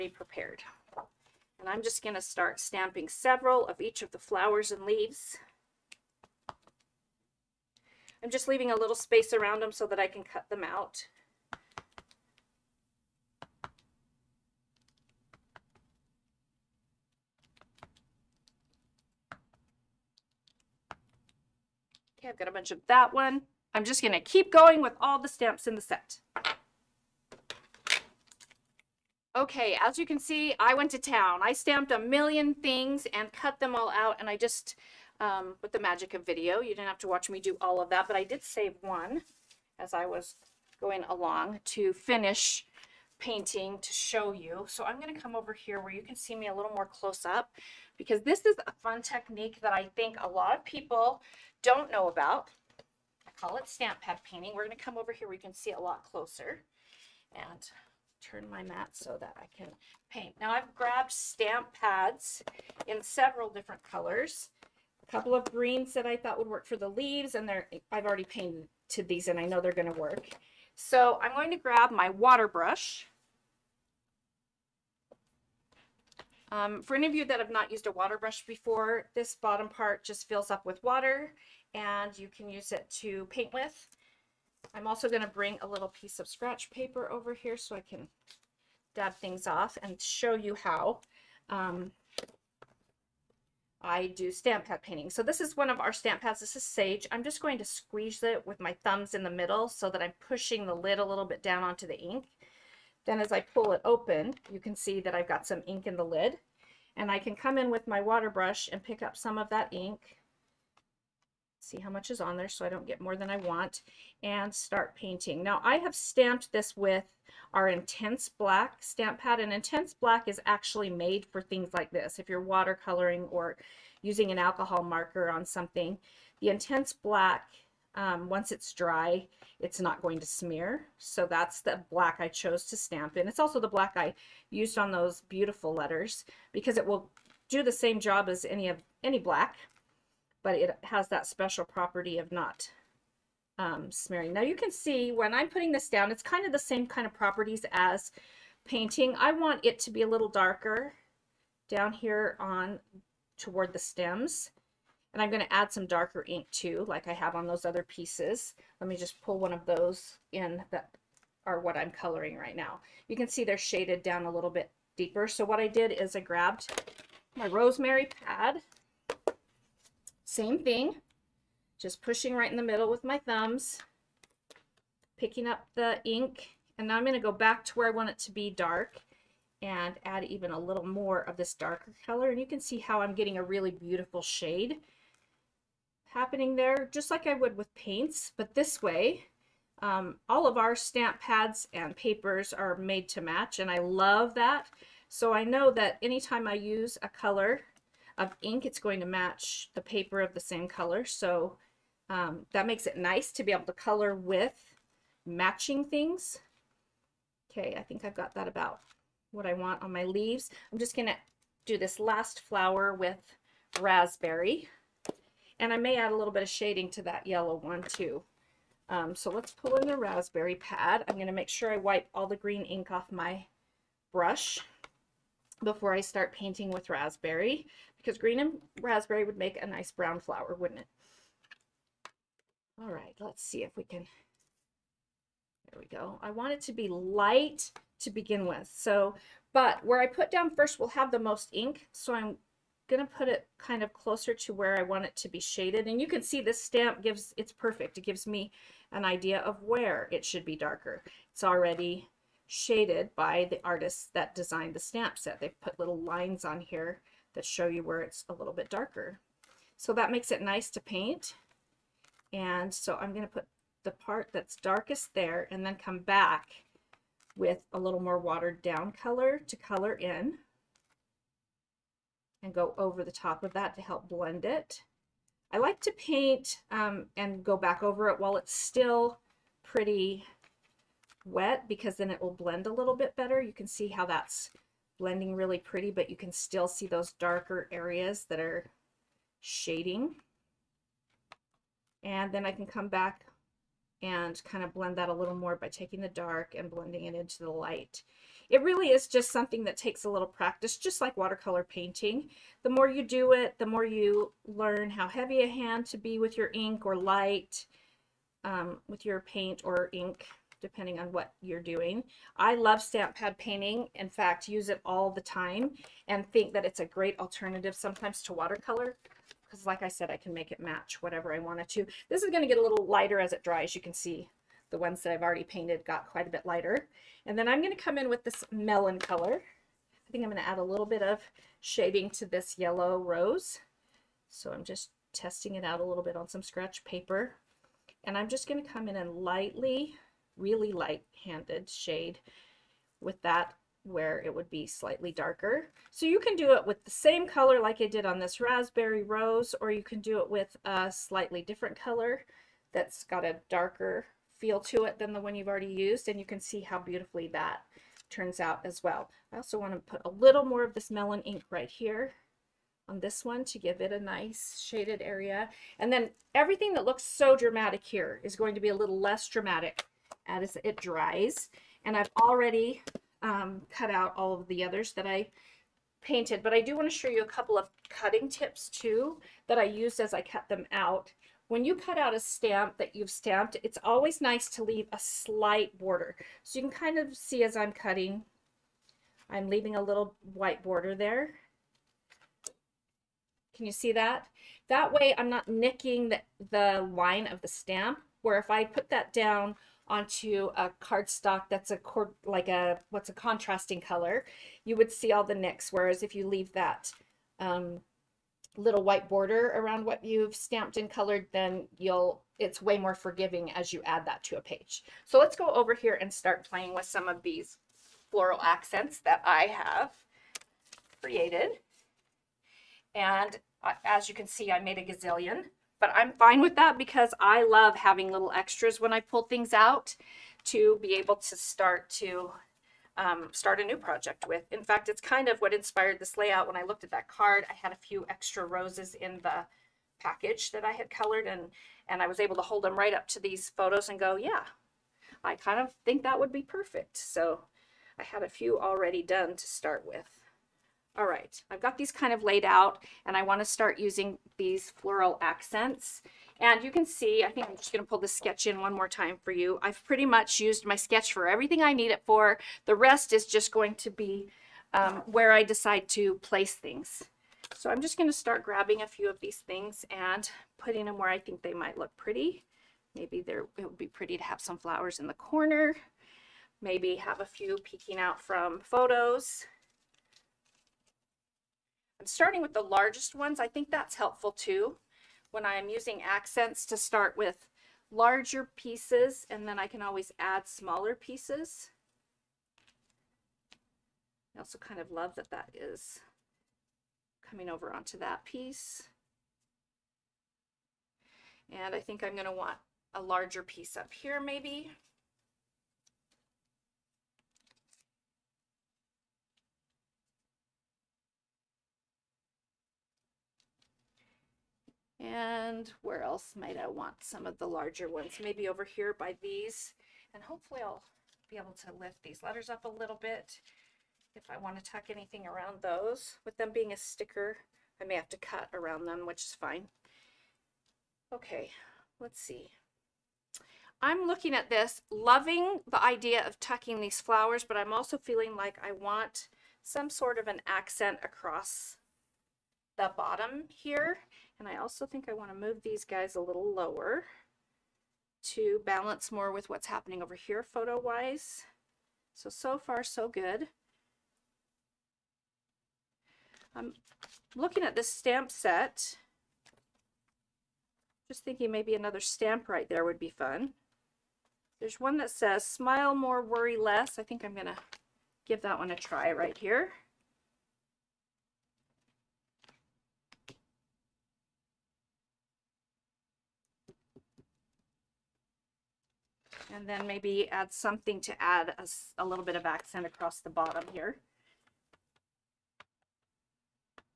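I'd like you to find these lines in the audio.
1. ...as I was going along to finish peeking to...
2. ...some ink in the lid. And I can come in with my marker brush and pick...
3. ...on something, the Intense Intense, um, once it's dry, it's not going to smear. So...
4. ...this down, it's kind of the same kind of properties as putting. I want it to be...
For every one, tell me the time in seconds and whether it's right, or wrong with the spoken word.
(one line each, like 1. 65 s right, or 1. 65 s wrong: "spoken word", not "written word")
1. 39 s wrong: "painting", not "peeking"
2. 105 s wrong: "water", not "marker"
3. 125 s wrong: "Black", not "Intense"
4. 145 s wrong: "painting", not "putting".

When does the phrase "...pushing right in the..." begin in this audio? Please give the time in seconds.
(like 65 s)
172 s.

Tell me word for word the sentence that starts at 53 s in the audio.
I call it stamp pad painting.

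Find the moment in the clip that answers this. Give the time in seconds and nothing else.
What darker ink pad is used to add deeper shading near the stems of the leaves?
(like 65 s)
167 s.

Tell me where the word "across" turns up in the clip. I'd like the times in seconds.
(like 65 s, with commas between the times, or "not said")
541 s, 582 s.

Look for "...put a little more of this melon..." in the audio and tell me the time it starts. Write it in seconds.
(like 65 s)
359 s.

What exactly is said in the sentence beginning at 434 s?
In fact, it's kind of what inspired this layout.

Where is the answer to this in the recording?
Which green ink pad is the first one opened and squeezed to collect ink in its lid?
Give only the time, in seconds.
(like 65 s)
96 s.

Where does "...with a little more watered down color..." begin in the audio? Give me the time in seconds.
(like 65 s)
267 s.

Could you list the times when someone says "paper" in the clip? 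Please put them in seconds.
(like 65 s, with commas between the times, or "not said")
86 s, 191 s, 199 s, 336 s.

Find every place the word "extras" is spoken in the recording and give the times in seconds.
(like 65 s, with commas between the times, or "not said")
428 s, 438 s.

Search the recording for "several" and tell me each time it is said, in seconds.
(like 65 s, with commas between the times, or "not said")
3 s, 63 s.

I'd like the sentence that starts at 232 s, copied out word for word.
All right, let's see if we can.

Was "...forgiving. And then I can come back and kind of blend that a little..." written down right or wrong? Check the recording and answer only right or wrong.
wrong.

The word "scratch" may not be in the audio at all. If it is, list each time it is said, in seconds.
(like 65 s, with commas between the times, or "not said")
86 s, 336 s.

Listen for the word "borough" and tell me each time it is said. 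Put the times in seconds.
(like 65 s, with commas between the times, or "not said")
not said.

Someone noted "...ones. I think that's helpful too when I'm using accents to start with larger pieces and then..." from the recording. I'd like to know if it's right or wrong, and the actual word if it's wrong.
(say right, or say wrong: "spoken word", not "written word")
right.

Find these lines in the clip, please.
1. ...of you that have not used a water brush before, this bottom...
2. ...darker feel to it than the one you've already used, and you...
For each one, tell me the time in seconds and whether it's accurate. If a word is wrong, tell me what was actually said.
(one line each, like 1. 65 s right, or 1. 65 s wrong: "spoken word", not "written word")
1. 77 s right
2. 353 s right.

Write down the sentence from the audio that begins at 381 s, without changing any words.
When you cut out a stamp that you've stamped, it's always nice to leave a slight border.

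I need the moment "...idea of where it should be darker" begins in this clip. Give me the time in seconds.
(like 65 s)
249 s.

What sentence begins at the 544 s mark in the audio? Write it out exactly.
And I also think I want to move these guys a little lower to balance more with what's happening over here photo-wise.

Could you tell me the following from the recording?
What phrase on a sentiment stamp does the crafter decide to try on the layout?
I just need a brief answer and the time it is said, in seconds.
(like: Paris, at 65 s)
Smile more, worry less, at 565 s.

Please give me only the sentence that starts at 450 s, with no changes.
All right, I've got these kind of laid out and I wanna start using these floral accents.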